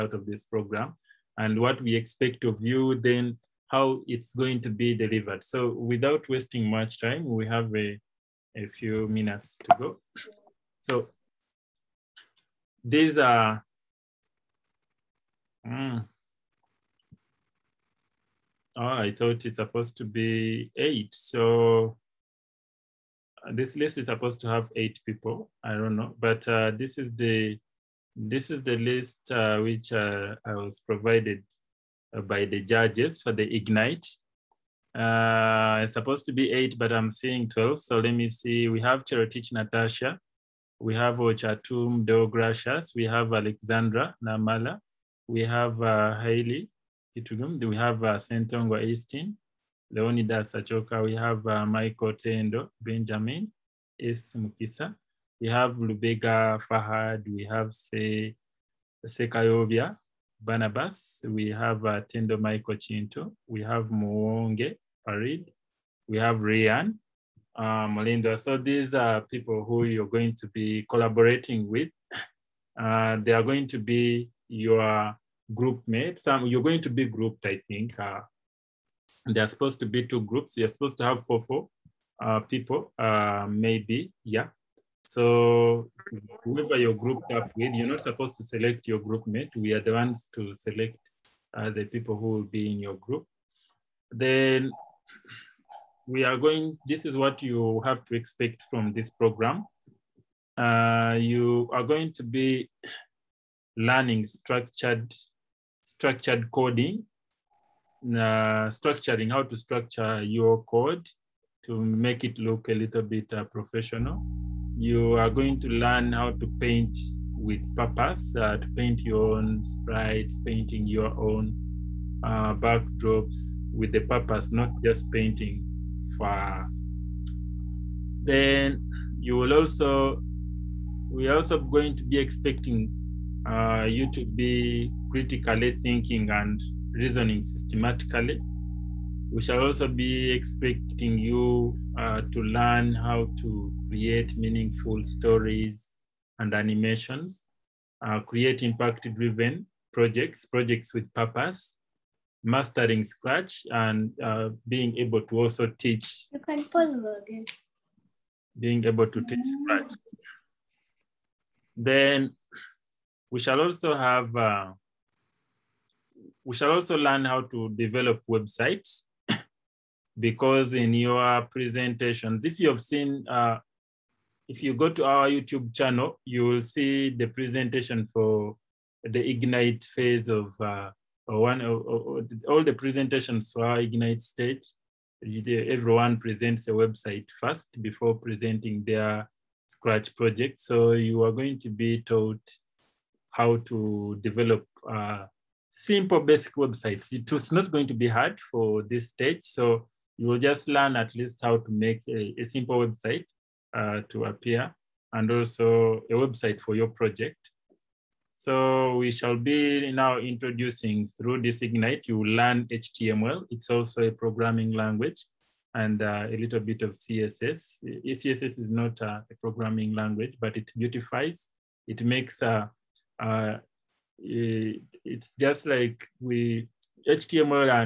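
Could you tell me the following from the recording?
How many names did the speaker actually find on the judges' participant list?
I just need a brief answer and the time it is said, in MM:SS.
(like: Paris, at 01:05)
12, at 00:37.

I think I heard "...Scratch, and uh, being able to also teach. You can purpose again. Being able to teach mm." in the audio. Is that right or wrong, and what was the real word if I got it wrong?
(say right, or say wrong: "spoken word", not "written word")
wrong: "pause", not "purpose".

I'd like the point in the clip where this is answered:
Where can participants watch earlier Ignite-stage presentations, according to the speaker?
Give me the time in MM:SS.
02:55.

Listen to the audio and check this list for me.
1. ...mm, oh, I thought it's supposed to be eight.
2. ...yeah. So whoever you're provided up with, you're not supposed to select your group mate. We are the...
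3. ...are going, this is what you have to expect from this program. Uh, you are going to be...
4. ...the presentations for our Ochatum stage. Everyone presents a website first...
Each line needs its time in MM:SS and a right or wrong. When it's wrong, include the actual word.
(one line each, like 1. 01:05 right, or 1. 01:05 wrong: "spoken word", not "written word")
1. 00:15 right
2. 01:24 wrong: "grouped", not "provided"
3. 01:36 right
4. 03:02 wrong: "Ignite", not "Ochatum".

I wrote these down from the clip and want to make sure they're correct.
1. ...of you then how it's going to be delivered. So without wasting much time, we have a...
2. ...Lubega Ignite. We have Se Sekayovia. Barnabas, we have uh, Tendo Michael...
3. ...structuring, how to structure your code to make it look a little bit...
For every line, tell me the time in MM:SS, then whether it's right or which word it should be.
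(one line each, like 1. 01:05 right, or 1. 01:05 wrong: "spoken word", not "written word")
1. 00:02 right
2. 00:55 wrong: "Fahad", not "Ignite"
3. 01:48 right.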